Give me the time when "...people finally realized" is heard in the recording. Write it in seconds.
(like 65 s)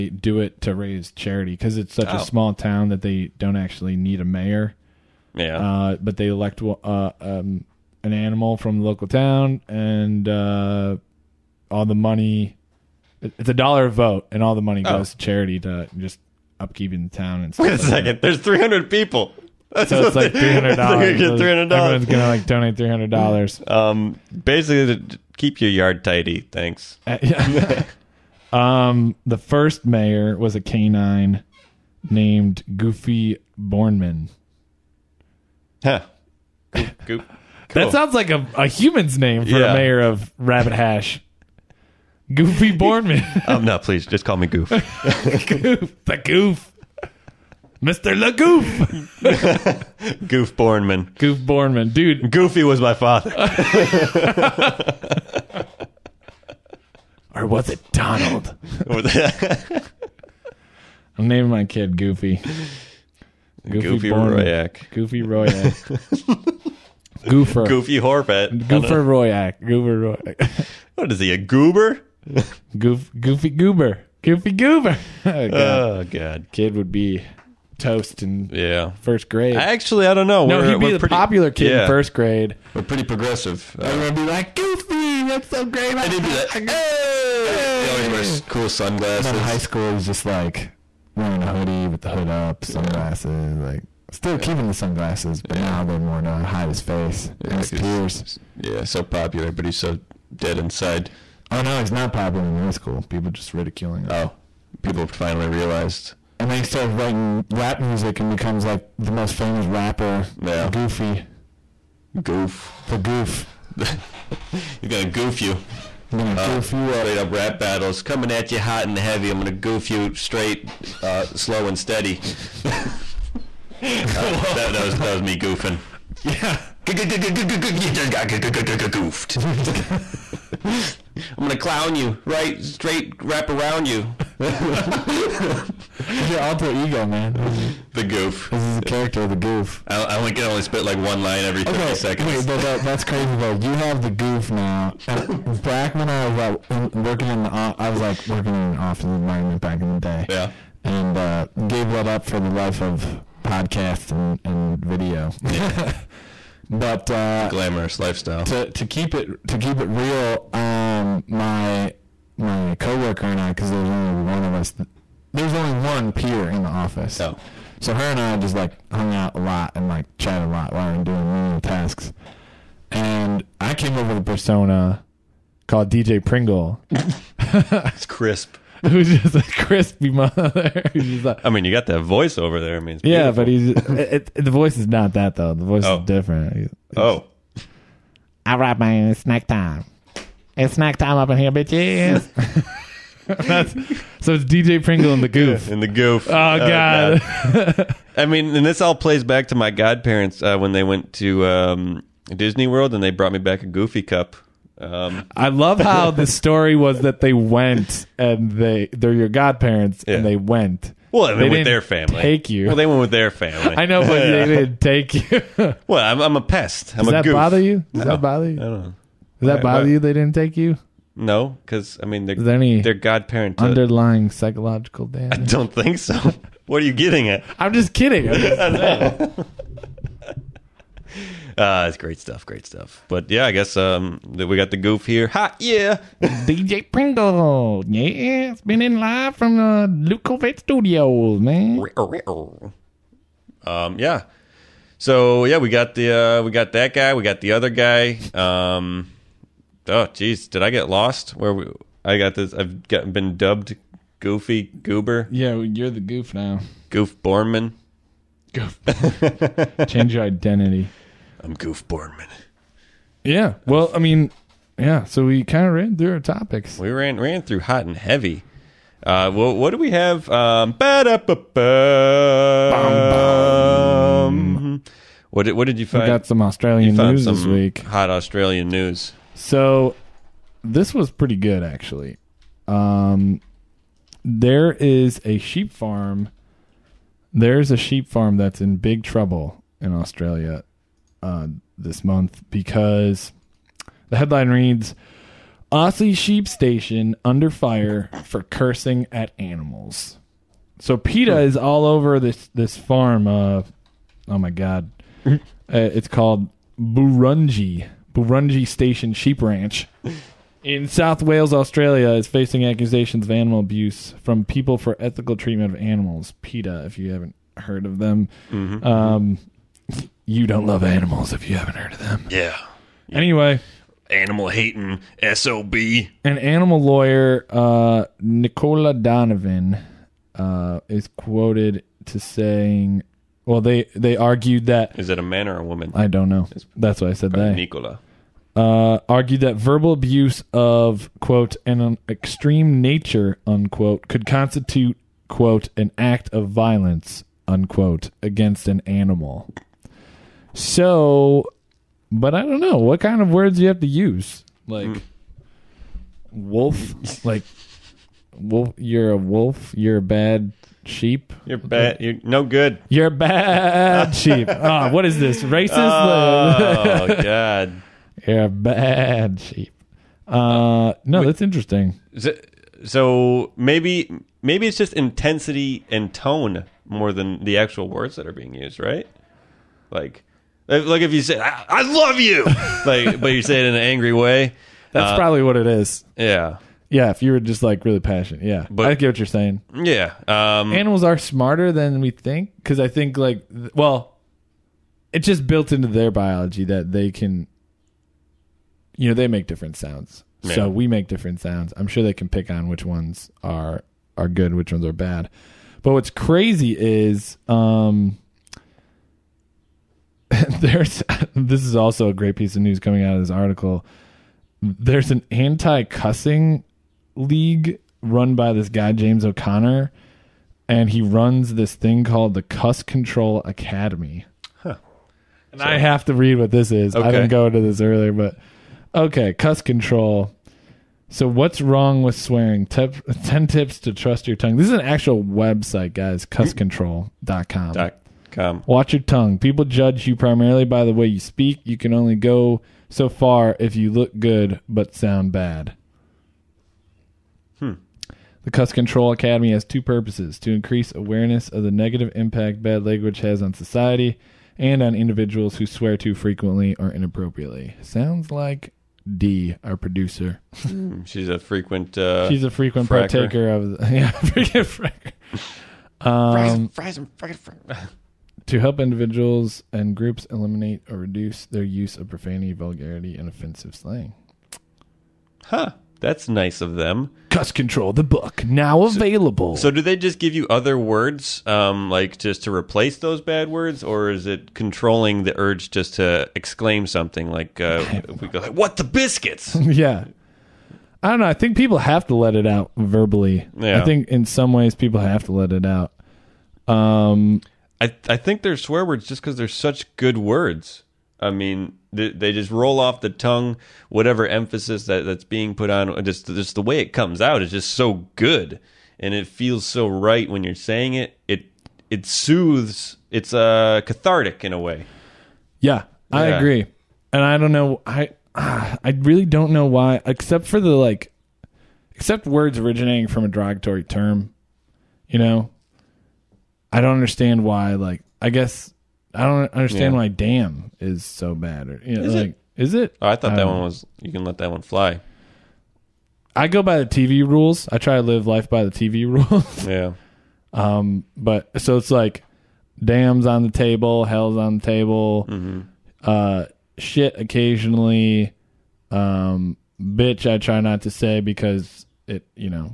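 104 s.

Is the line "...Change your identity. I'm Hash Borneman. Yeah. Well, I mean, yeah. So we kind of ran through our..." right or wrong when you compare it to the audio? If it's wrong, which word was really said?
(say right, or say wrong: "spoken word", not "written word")
wrong: "Goof", not "Hash".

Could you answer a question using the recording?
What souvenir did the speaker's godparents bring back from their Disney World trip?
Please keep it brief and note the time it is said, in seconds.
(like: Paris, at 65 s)
a Goofy cup, at 203 s.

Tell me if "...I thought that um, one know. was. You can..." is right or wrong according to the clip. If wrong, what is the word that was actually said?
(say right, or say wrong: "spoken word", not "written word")
right.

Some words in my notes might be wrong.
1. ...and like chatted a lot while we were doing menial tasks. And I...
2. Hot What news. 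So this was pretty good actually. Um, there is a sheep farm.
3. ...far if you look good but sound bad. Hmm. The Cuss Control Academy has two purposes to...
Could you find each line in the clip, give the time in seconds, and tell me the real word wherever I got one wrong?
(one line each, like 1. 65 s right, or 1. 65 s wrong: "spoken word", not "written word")
1. 169 s right
2. 277 s wrong: "Australian", not "What"
3. 443 s right.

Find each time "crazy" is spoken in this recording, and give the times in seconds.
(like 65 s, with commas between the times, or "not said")
143 s, 406 s.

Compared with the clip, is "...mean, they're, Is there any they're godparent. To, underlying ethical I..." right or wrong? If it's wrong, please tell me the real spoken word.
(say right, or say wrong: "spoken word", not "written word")
wrong: "psychological", not "ethical".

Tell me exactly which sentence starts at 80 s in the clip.
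No, we're, he'd be the pretty, popular kid yeah.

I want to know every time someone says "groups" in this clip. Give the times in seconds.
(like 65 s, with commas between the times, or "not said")
469 s.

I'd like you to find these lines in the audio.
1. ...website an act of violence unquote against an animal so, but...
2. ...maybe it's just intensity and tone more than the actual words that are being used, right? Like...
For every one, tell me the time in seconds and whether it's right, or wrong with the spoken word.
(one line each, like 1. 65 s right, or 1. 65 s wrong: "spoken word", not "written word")
1. 345 s wrong: "quote", not "website"
2. 374 s right.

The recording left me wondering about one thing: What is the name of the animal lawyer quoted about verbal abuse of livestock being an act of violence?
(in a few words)
Nicola Donovan.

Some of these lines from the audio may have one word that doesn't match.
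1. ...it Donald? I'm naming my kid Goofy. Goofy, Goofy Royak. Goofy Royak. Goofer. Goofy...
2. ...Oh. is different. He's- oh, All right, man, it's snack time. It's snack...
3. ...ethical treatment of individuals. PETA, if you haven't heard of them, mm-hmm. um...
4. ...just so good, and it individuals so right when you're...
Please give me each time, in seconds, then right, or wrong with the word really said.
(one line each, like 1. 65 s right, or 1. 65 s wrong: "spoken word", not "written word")
1. 57 s right
2. 185 s right
3. 314 s wrong: "animals", not "individuals"
4. 507 s wrong: "feels", not "individuals".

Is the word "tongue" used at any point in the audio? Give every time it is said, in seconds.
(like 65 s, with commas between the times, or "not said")
434 s, 439 s, 503 s.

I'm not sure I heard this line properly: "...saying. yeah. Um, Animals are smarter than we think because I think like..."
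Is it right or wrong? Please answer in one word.
right.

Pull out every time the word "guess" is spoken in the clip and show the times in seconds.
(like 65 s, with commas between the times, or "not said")
233 s, 528 s.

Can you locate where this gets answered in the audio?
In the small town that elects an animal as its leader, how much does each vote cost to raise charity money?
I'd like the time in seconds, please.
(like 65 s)
13 s.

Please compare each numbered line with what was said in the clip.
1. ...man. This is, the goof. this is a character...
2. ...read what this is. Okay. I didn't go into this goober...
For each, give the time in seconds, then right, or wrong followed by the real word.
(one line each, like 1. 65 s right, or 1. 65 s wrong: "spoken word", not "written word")
1. 137 s right
2. 426 s wrong: "earlier", not "goober".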